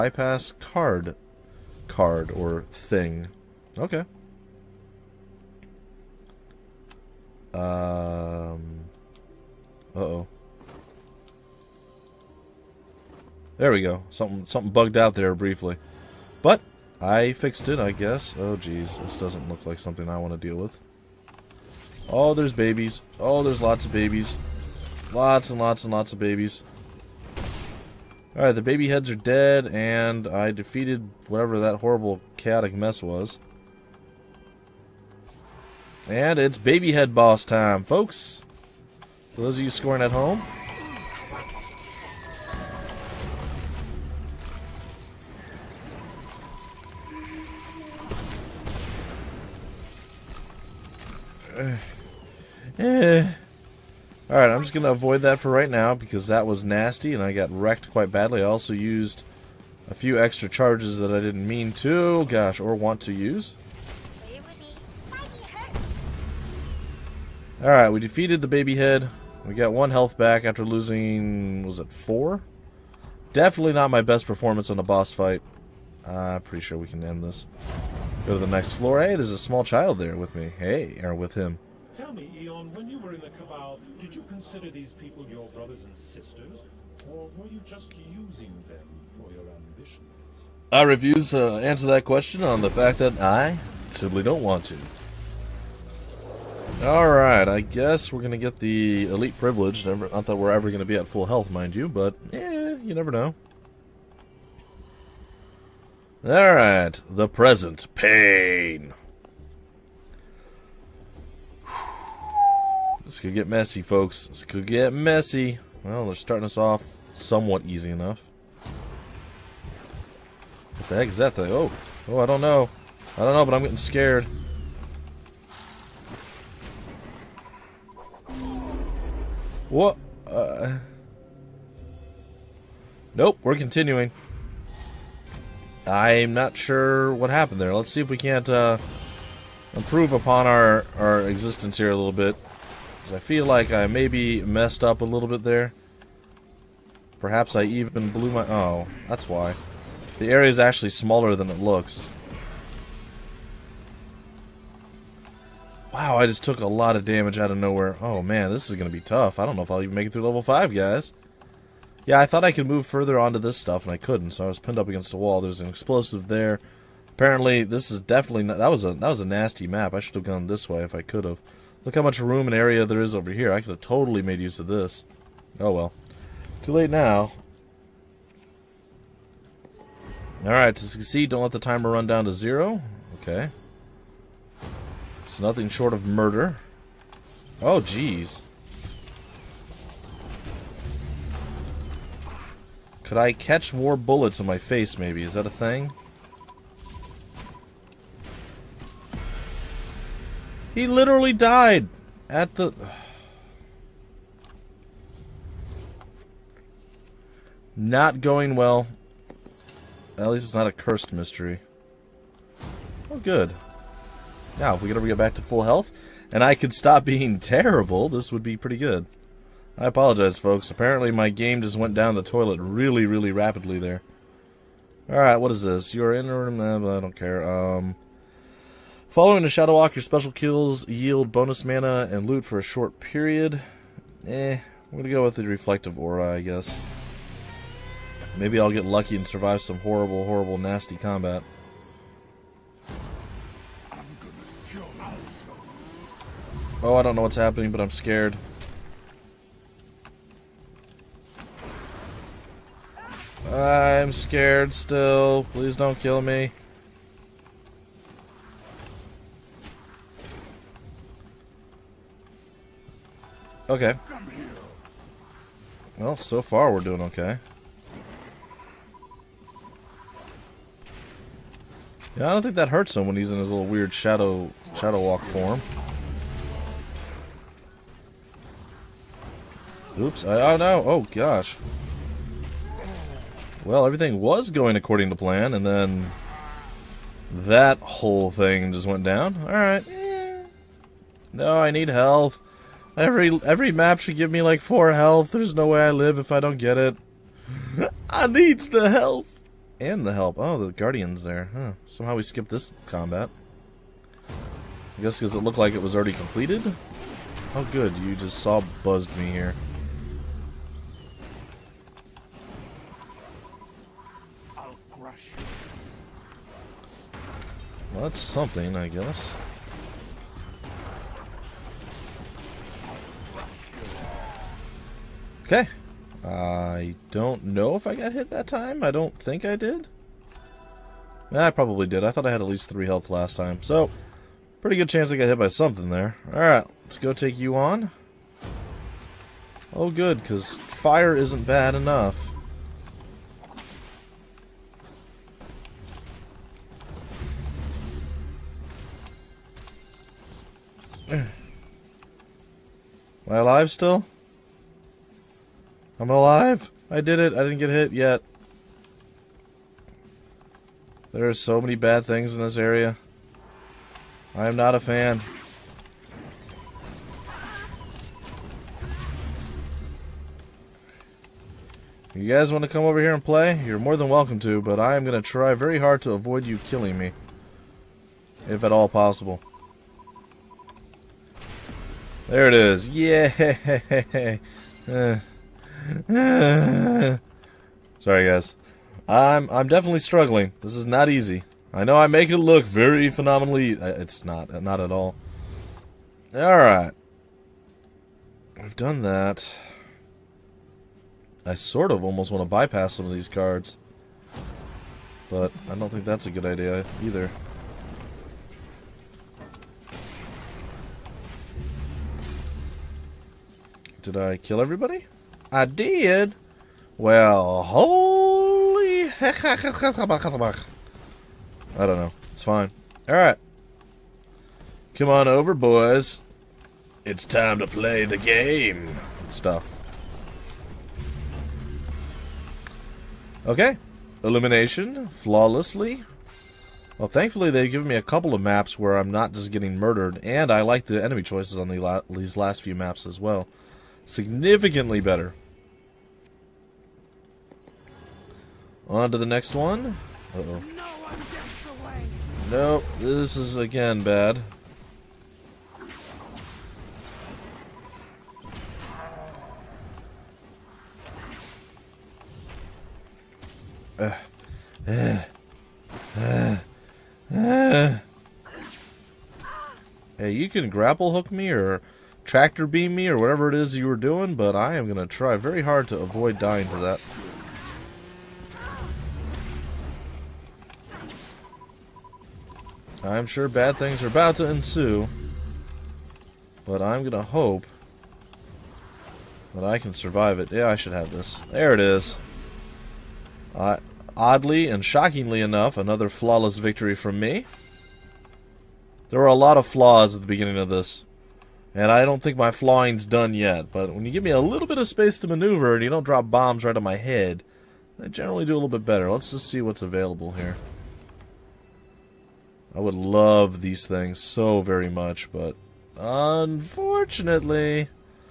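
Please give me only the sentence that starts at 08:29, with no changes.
Let's just see what's available here.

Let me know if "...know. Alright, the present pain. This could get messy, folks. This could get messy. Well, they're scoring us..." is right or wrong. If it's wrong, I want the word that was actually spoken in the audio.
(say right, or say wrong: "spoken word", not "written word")
wrong: "starting", not "scoring".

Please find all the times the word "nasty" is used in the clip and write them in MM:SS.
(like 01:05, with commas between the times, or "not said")
00:56, 02:49, 04:00.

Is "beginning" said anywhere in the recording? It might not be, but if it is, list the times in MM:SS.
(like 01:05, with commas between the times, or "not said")
08:20.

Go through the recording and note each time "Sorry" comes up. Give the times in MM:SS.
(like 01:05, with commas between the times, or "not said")
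06:26.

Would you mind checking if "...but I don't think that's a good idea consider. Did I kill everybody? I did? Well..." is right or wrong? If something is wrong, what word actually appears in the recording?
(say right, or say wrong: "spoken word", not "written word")
wrong: "either", not "consider".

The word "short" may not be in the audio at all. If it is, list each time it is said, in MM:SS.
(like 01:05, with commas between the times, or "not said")
03:05, 03:52.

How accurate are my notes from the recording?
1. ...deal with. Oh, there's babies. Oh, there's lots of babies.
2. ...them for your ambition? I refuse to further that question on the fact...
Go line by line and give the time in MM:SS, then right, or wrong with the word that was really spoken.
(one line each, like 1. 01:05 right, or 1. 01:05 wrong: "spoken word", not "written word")
1. 00:20 right
2. 01:28 wrong: "answer", not "further".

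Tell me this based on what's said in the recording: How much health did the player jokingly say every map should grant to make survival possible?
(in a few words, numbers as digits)
4.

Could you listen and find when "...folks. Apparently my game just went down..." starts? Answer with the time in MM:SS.
03:40.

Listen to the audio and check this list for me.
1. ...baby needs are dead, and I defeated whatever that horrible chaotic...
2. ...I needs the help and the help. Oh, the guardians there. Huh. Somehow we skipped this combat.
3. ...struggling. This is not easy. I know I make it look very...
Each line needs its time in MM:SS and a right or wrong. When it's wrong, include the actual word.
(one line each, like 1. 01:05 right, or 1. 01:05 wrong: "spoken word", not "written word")
1. 00:28 wrong: "heads", not "needs"
2. 04:58 right
3. 06:29 right.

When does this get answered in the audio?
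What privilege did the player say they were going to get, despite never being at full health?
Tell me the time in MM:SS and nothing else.
01:39.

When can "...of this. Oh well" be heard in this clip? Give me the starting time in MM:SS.
02:54.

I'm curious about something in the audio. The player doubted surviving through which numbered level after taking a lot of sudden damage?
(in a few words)
level 5.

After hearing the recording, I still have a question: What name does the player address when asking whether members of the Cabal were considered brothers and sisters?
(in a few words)
Aeon.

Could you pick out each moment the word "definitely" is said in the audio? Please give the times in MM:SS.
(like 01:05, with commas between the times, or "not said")
01:13, 02:47, 06:29.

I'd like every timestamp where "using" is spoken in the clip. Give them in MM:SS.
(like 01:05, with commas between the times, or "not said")
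01:28.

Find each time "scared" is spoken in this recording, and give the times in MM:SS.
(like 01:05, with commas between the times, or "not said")
02:03, 04:07, 04:14.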